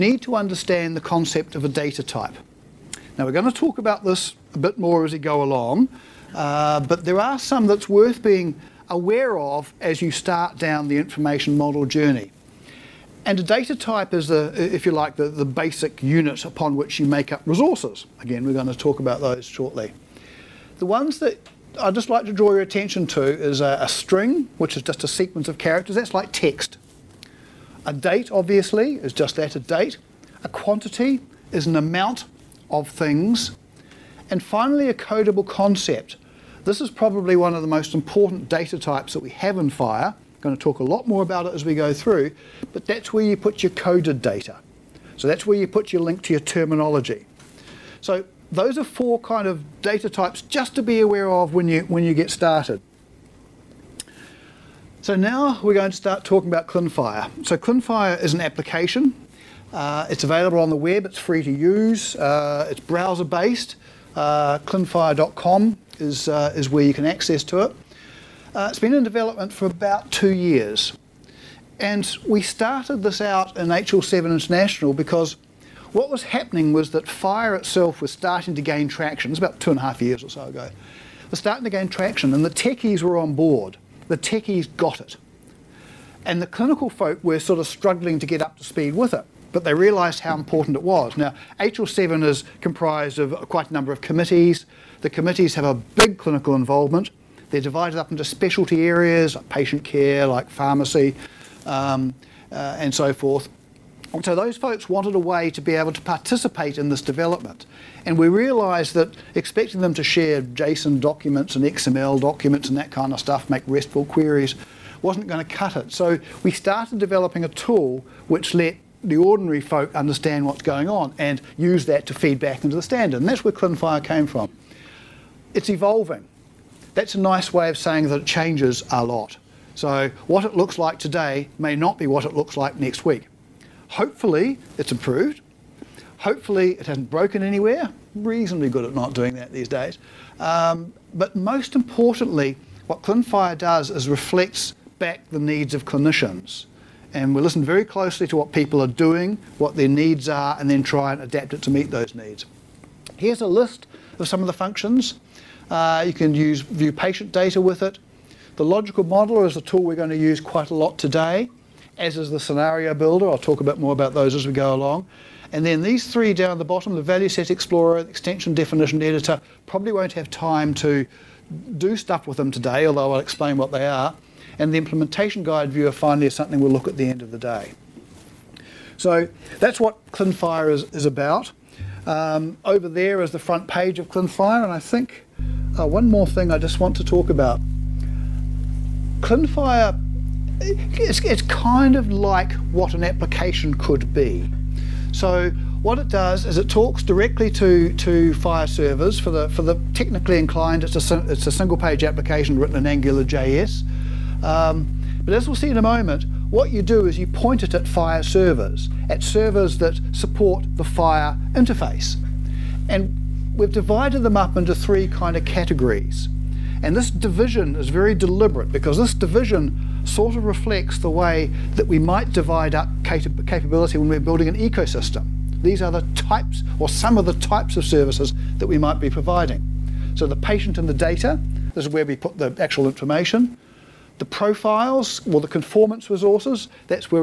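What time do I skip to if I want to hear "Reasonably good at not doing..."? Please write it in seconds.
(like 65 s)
138 s.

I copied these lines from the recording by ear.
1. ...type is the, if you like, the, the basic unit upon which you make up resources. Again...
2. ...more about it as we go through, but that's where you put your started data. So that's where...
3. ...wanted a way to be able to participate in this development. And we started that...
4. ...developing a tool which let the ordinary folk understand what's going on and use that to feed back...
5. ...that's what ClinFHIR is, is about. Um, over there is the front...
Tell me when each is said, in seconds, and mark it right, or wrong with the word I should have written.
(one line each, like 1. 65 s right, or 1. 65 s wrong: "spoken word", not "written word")
1. 13 s right
2. 41 s wrong: "coded", not "started"
3. 104 s wrong: "realised", not "started"
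4. 116 s right
5. 179 s right.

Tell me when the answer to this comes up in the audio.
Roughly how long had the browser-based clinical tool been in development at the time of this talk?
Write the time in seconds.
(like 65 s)
69 s.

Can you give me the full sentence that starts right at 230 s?
So the patient and the data, this is where we put the actual information.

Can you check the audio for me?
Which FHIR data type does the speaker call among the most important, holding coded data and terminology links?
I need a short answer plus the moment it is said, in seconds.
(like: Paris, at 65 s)
codable concept, at 34 s.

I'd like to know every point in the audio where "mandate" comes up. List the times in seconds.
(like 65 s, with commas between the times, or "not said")
not said.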